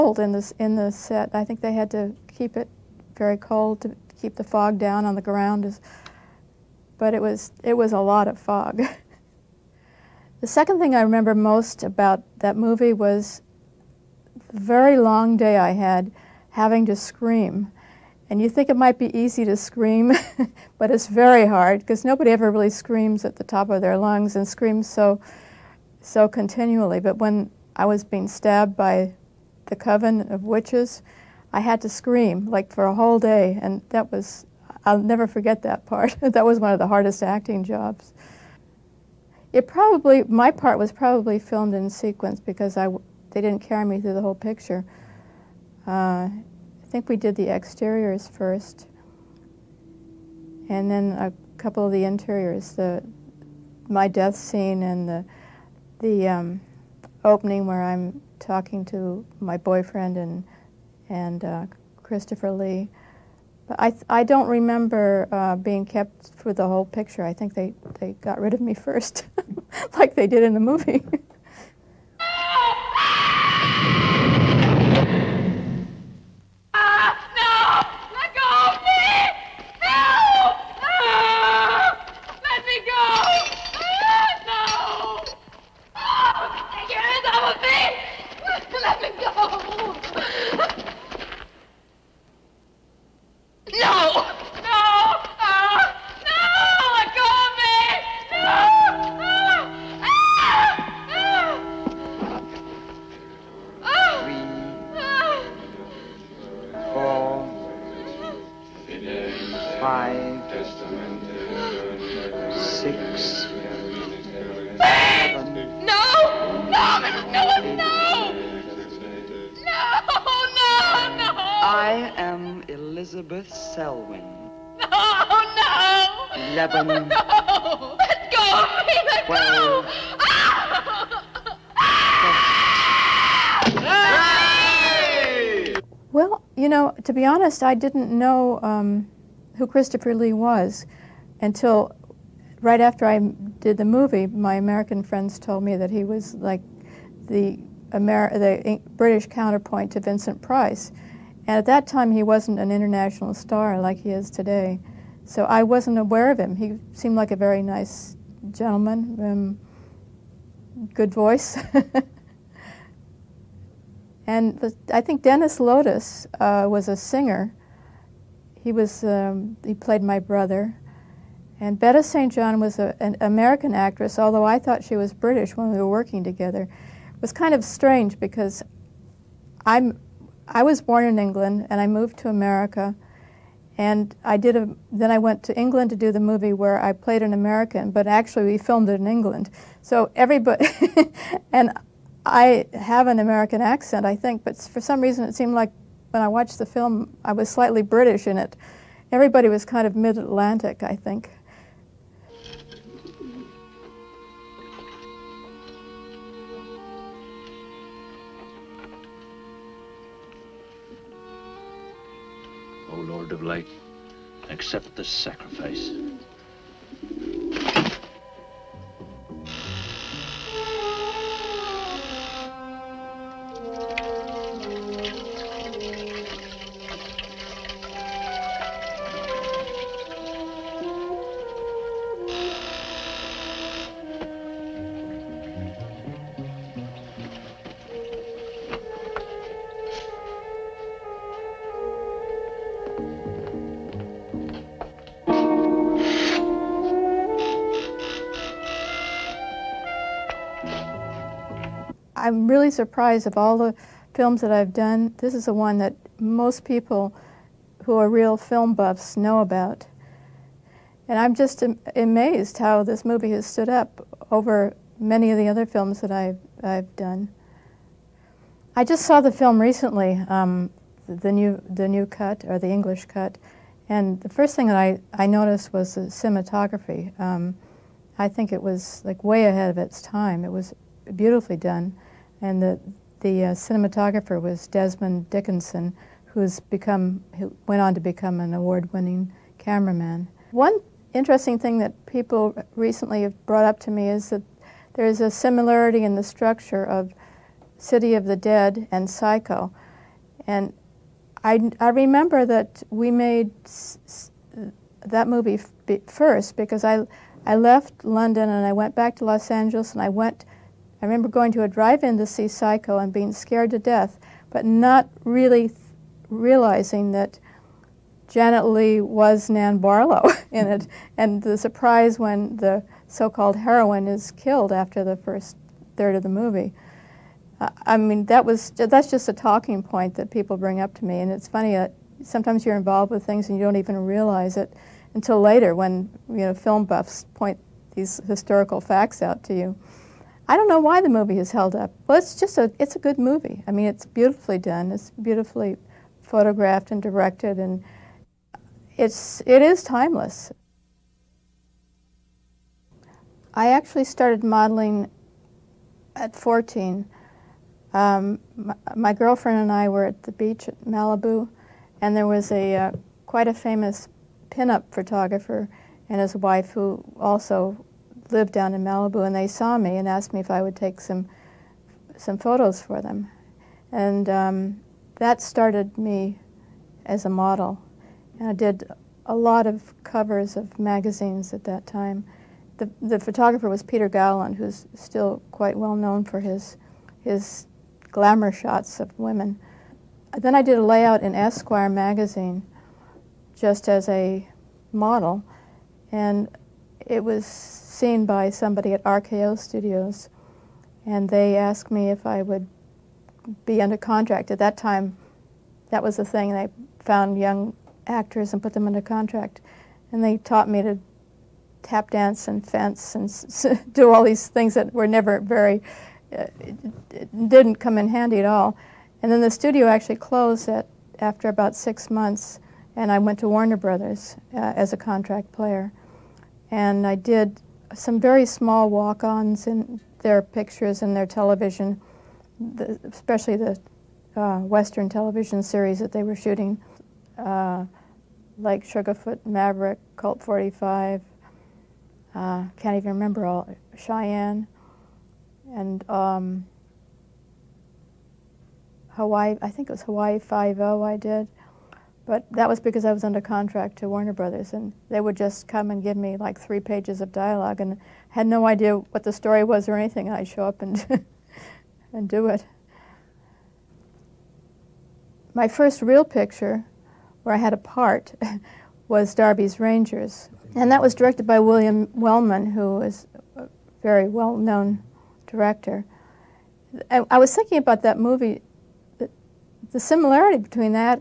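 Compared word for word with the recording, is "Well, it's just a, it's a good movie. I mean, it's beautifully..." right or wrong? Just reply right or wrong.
right.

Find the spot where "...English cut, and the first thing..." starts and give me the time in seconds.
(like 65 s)
272 s.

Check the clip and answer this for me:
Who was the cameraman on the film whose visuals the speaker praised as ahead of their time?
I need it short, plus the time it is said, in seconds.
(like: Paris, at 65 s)
Desmond Dickinson, at 284 s.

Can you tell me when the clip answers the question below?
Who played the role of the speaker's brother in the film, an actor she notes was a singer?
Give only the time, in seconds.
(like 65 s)
165 s.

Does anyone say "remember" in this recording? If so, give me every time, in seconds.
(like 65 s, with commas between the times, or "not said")
11 s, 64 s, 301 s, 311 s, 443 s.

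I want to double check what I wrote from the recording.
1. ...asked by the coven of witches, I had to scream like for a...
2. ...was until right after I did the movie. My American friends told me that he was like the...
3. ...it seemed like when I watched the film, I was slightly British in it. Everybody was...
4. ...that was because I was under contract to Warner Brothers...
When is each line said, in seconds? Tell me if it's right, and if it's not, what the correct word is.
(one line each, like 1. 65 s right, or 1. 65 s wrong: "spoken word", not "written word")
1. 28 s wrong: "stabbed", not "asked"
2. 140 s right
3. 195 s right
4. 452 s right.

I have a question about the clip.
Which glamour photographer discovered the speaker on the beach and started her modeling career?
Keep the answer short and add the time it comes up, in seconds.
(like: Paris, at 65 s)
Peter Gowland, at 383 s.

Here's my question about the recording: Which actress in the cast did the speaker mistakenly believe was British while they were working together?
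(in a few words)
Betta St. John.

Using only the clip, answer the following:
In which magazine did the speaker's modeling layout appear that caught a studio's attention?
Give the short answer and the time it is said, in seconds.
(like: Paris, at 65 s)
Esquire, at 391 s.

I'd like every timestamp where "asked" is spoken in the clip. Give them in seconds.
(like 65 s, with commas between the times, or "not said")
370 s, 401 s.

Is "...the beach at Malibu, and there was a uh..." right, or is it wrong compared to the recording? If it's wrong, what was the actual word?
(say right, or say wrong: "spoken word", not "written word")
right.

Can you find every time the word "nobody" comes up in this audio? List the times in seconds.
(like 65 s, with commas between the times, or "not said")
22 s.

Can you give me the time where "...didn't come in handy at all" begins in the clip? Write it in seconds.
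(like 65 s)
417 s.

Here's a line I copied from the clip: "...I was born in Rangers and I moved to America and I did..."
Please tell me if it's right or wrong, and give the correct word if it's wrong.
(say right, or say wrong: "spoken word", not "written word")
wrong: "England", not "Rangers".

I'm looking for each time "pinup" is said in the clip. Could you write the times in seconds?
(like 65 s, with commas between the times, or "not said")
364 s.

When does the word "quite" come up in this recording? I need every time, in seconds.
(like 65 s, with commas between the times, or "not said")
363 s, 385 s.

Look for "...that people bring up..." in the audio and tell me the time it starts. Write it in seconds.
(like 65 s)
330 s.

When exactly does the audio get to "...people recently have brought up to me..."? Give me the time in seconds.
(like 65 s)
292 s.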